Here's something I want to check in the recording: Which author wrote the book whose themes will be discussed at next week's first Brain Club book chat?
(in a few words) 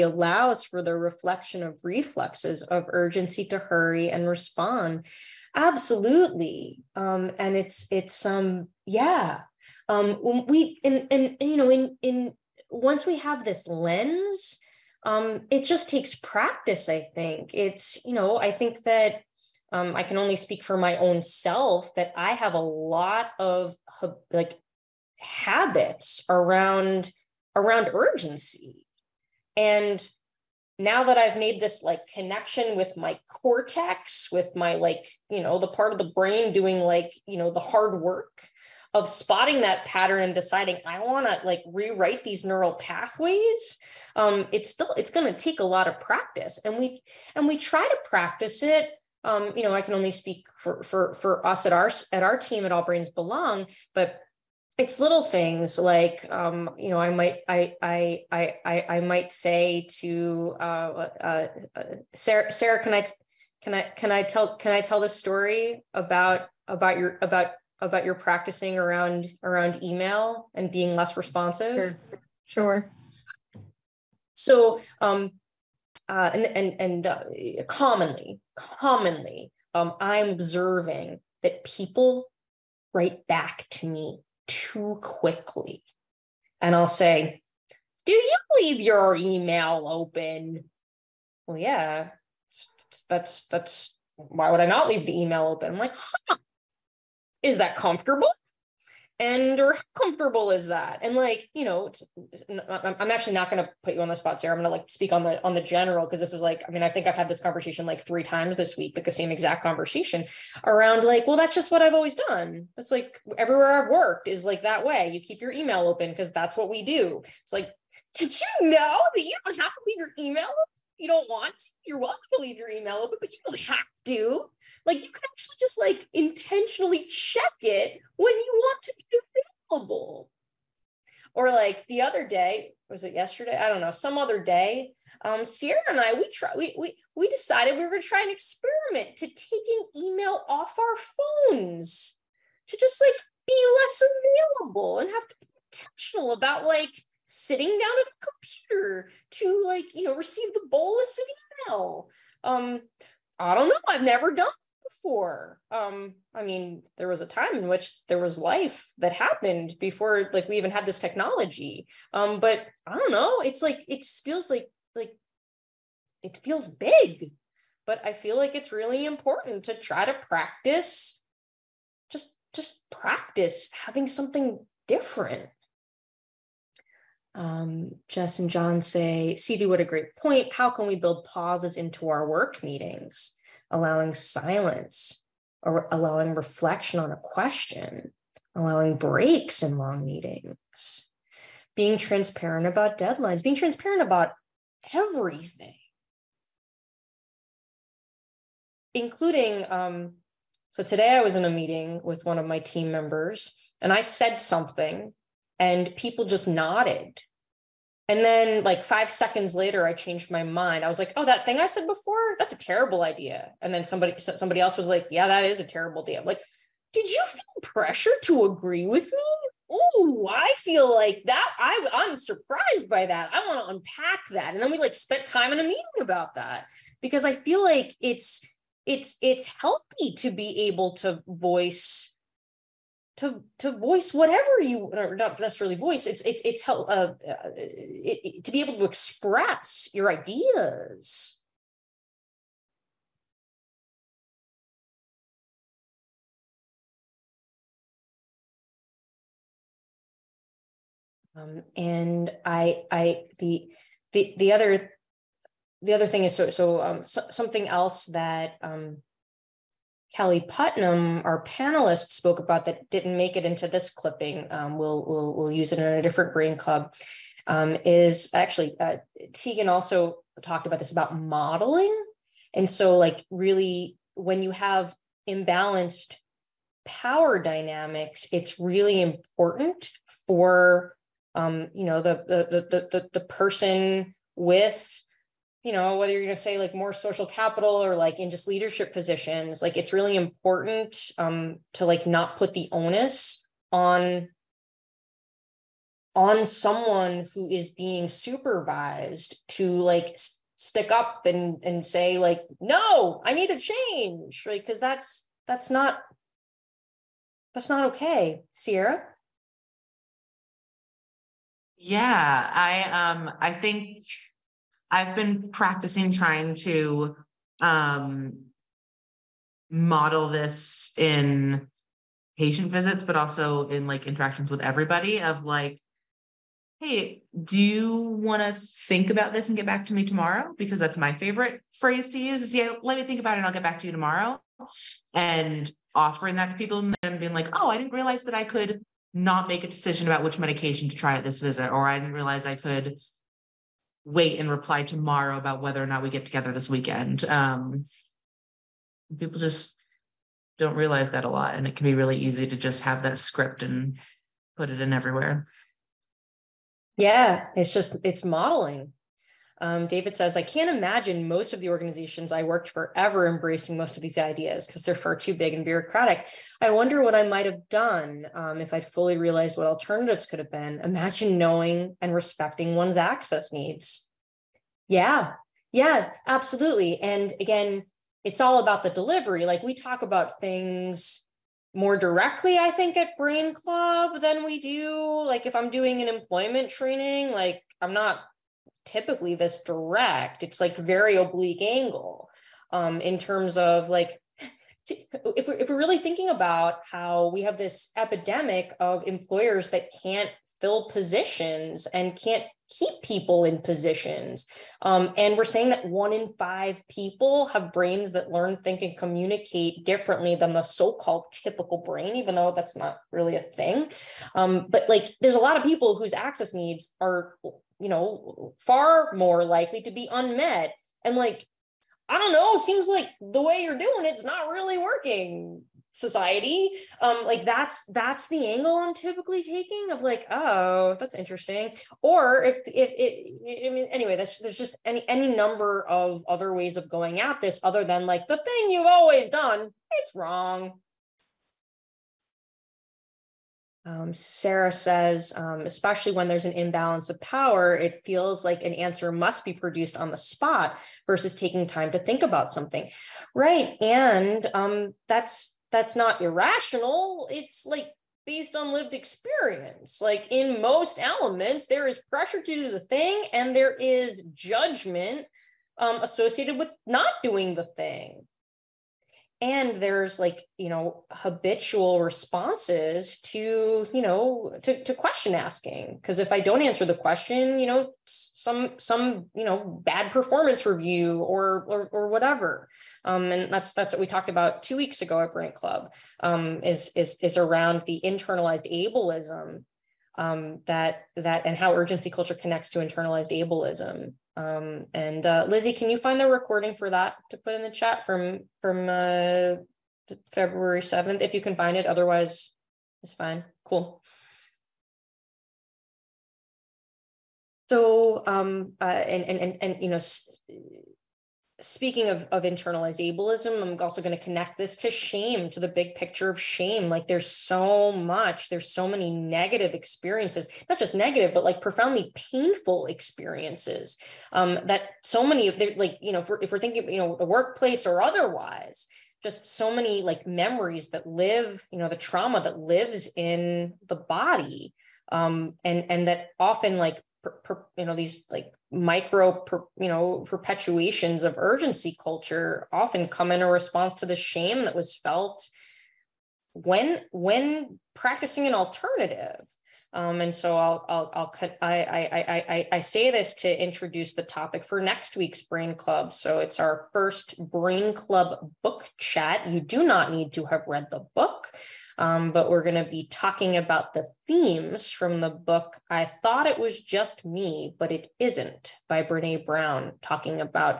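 Brene Brown.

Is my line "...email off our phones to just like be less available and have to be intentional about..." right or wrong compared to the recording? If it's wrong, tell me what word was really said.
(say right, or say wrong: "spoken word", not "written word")
right.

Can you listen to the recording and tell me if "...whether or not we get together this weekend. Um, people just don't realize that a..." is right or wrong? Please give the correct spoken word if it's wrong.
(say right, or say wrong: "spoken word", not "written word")
right.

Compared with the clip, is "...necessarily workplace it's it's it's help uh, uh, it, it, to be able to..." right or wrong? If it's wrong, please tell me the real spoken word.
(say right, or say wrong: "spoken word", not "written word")
wrong: "voice", not "workplace".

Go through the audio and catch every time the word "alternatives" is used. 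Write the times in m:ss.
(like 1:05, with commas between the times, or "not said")
6:09, 9:08.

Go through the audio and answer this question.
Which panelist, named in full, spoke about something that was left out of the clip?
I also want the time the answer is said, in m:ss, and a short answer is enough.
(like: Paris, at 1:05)
Kelly Putnam, at 4:20.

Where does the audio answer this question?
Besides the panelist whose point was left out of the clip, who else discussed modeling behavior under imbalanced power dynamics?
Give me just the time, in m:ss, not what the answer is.
4:29.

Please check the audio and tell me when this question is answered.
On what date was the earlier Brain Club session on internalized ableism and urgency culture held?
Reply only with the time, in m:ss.
8:20.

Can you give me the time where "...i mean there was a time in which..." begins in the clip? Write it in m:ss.
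2:36.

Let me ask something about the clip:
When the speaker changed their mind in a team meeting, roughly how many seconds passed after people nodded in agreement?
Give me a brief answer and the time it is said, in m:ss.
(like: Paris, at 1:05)
5, at 3:28.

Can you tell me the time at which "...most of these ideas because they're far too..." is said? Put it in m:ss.
6:03.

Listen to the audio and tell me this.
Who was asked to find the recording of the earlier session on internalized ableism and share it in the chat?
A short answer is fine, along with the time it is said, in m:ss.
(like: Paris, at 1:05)
Lizzie, at 8:15.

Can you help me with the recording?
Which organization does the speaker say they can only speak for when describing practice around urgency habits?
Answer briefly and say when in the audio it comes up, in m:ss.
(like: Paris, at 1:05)
All Brains Belong, at 0:52.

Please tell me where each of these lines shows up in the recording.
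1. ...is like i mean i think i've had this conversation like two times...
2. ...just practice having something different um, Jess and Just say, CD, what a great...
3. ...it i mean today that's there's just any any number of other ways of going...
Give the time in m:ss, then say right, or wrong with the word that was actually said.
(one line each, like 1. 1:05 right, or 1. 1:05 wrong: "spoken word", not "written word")
1. 1:46 wrong: "three", not "two"
2. 2:52 wrong: "John", not "Just"
3. 7:12 wrong: "anyway", not "today".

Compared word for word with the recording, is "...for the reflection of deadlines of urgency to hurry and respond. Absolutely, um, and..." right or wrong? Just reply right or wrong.
wrong.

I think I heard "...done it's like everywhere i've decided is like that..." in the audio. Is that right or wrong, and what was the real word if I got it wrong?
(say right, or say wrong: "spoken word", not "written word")
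wrong: "worked", not "decided".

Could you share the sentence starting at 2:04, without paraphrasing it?
Like you can actually just like intentionally check it when you want to be available.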